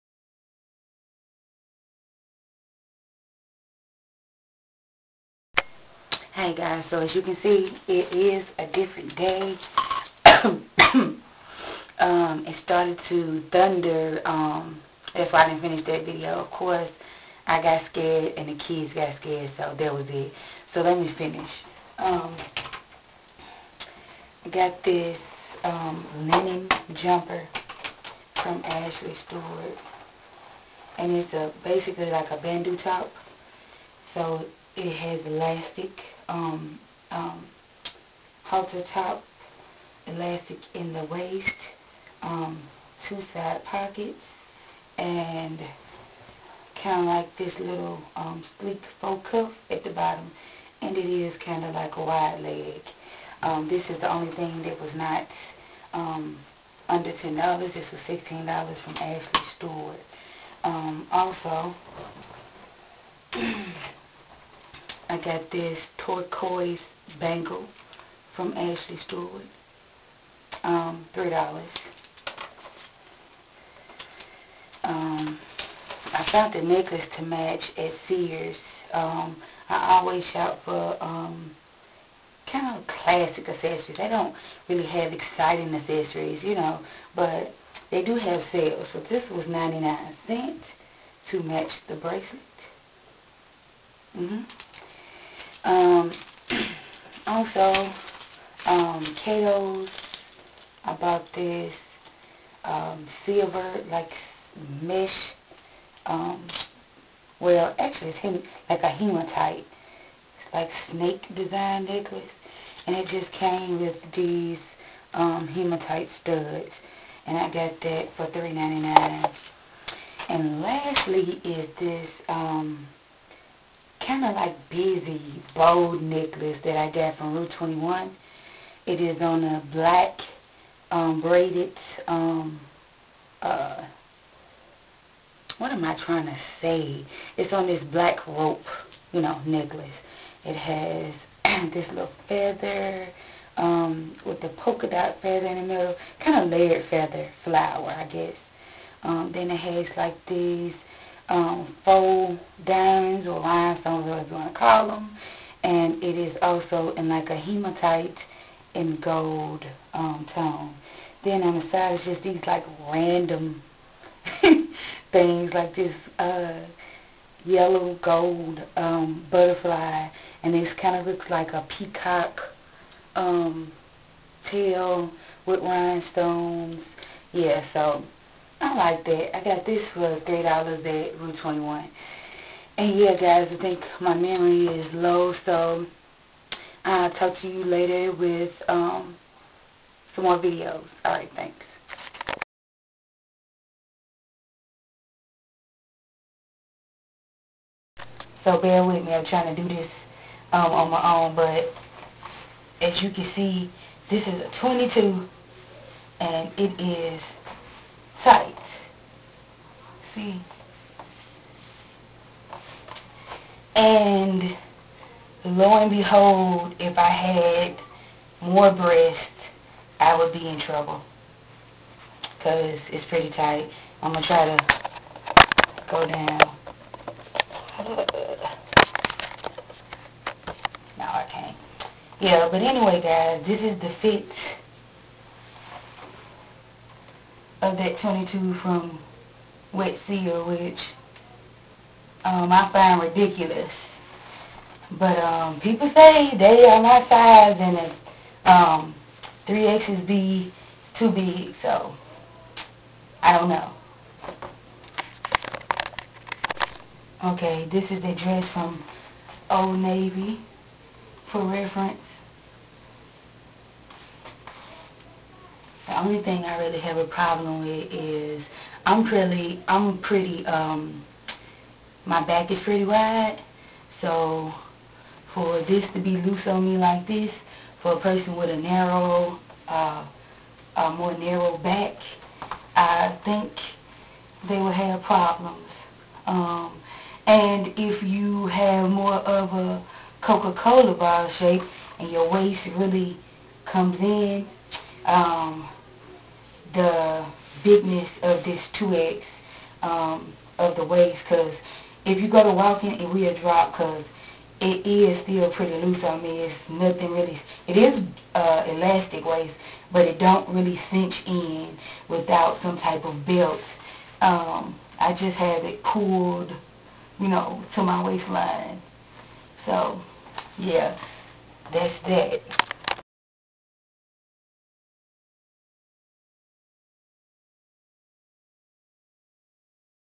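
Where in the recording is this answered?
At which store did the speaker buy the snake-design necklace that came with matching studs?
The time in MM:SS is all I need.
01:39.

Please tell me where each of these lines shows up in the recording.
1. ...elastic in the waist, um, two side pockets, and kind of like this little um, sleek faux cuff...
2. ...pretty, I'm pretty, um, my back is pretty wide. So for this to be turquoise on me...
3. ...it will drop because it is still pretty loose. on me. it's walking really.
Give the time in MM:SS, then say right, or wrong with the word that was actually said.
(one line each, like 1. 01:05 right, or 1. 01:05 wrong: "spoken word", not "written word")
1. 00:40 right
2. 04:29 wrong: "loose", not "turquoise"
3. 05:02 wrong: "nothing", not "walking".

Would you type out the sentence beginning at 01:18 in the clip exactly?
Um, I always shop for um, kind of classic accessories.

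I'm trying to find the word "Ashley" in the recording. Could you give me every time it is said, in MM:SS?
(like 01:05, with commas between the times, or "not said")
00:28, 00:58, 01:08.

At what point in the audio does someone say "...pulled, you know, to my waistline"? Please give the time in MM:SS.
05:15.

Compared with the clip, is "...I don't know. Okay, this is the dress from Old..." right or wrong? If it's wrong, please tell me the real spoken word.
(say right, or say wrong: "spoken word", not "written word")
right.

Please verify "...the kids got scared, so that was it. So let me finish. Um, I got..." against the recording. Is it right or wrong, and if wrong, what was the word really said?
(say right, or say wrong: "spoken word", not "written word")
right.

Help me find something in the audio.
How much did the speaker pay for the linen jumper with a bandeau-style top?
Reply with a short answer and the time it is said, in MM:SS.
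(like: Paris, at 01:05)
$16, at 00:58.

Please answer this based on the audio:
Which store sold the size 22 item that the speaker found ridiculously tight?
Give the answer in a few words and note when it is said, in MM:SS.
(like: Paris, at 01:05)
Wet Seal, at 03:59.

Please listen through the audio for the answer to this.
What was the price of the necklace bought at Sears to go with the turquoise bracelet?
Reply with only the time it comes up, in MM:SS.
01:29.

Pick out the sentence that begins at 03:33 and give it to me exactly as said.
And lo and behold, if I had more breasts, I would be in trouble.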